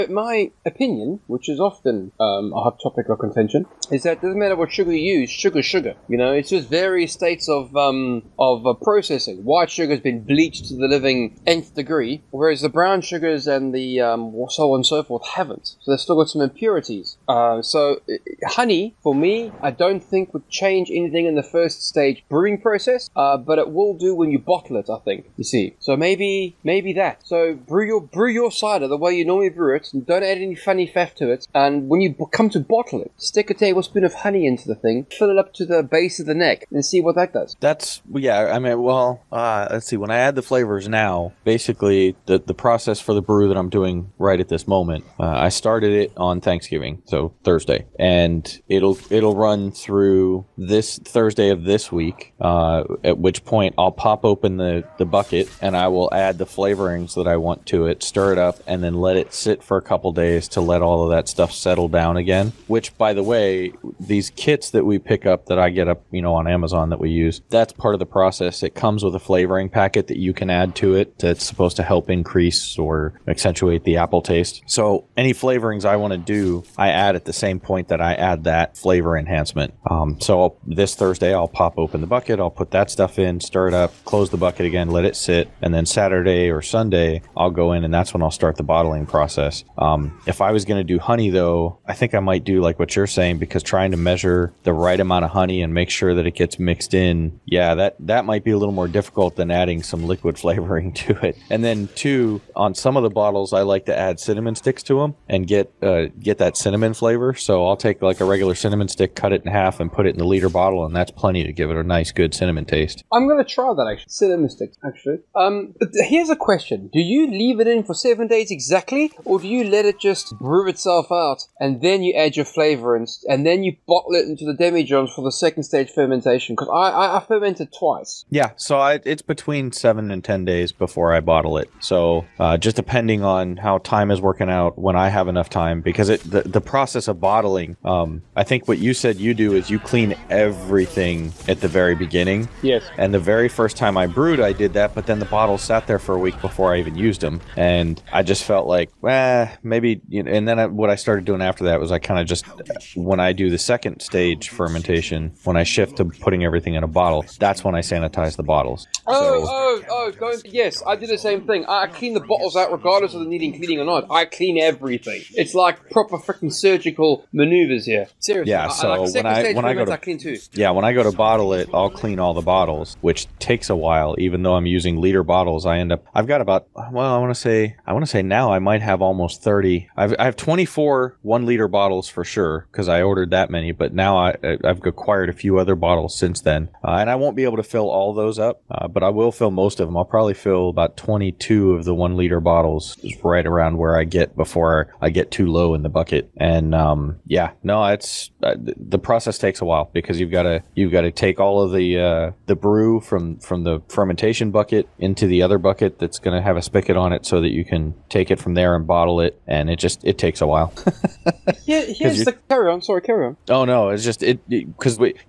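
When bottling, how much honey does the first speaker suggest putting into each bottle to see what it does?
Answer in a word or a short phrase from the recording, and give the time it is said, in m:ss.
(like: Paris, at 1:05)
a tablespoon, at 0:33.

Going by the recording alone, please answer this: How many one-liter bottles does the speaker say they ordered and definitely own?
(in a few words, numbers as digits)
24.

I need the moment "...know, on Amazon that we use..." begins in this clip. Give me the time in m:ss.
1:06.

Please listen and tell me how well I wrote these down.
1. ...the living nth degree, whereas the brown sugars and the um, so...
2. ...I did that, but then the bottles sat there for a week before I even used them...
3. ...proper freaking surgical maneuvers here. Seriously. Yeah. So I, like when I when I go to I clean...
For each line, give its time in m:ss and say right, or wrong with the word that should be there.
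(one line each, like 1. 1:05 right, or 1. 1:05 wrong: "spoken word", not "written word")
1. 0:10 right
2. 2:24 right
3. 2:45 right.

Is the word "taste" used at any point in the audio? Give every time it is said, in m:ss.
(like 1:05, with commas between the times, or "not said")
1:14, 1:52.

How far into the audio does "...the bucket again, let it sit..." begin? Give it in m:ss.
1:24.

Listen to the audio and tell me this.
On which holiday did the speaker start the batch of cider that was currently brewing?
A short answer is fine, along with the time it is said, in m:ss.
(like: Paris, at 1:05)
Thanksgiving, at 0:46.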